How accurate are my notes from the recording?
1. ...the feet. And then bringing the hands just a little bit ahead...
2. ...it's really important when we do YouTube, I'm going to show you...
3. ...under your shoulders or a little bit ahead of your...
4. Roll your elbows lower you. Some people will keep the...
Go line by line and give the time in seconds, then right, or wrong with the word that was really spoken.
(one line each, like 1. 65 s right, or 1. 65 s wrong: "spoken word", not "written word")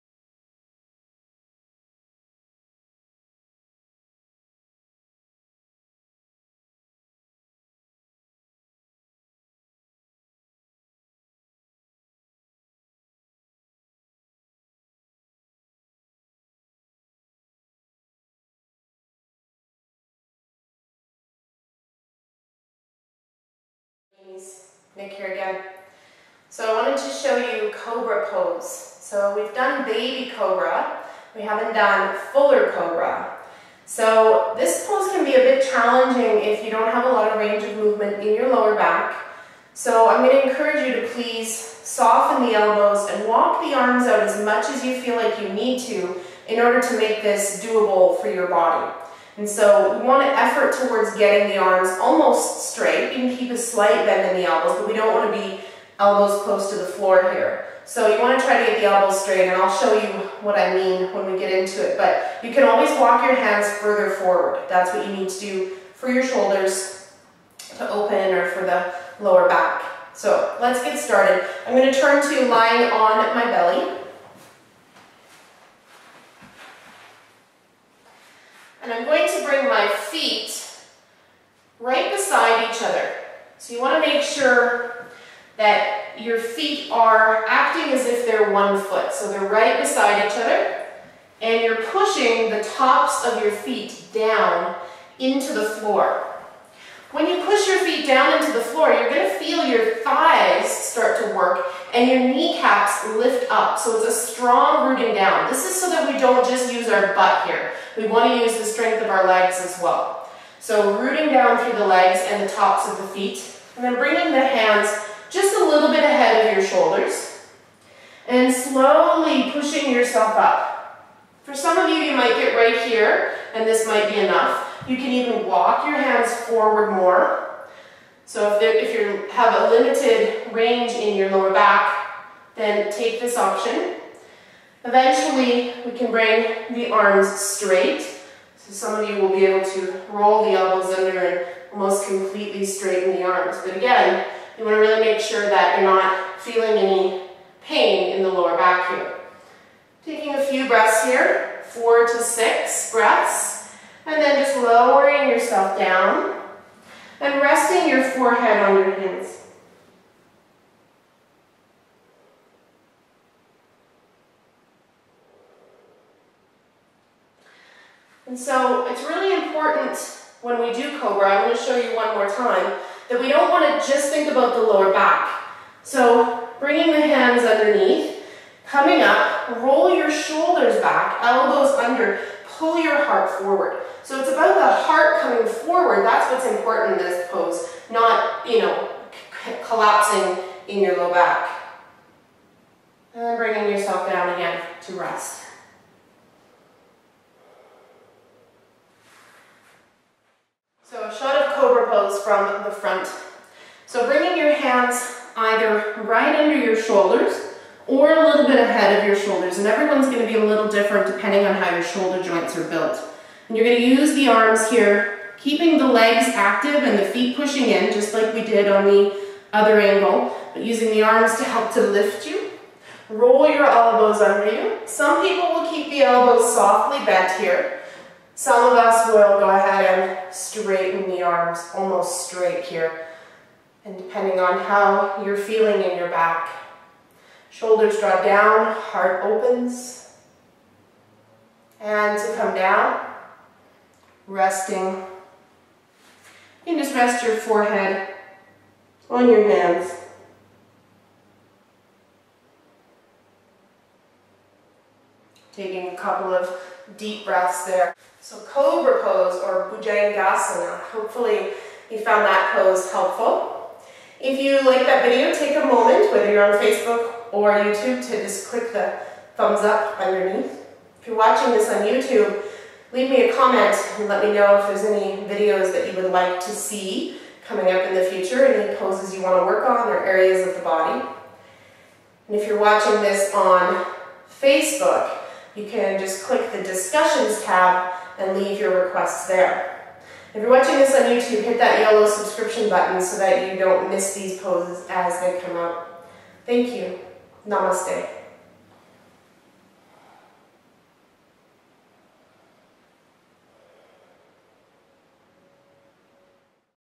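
1. 112 s right
2. 168 s wrong: "Cobra", not "YouTube"
3. 206 s right
4. 223 s wrong: "under", not "lower".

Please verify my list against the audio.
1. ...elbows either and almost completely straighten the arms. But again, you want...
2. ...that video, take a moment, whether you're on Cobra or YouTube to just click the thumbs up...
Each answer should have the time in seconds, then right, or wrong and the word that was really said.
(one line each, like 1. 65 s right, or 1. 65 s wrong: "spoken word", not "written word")
1. 140 s wrong: "under", not "either"
2. 264 s wrong: "Facebook", not "Cobra".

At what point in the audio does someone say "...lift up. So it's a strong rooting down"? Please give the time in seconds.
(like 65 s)
103 s.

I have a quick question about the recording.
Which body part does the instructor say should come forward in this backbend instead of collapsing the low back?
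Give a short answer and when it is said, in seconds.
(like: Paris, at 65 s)
The heart, at 184 s.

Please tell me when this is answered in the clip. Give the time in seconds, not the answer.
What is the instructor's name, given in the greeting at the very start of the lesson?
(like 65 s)
24 s.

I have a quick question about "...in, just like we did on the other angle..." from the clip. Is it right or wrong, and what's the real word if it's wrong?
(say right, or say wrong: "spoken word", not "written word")
right.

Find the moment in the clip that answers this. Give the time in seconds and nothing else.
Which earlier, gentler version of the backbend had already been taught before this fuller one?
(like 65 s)
29 s.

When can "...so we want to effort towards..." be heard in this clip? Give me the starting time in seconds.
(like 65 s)
49 s.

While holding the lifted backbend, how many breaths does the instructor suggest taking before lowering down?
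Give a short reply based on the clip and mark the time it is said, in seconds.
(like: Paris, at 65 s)
4 to 6, at 151 s.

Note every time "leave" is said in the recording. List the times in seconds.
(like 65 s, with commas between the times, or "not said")
272 s, 288 s.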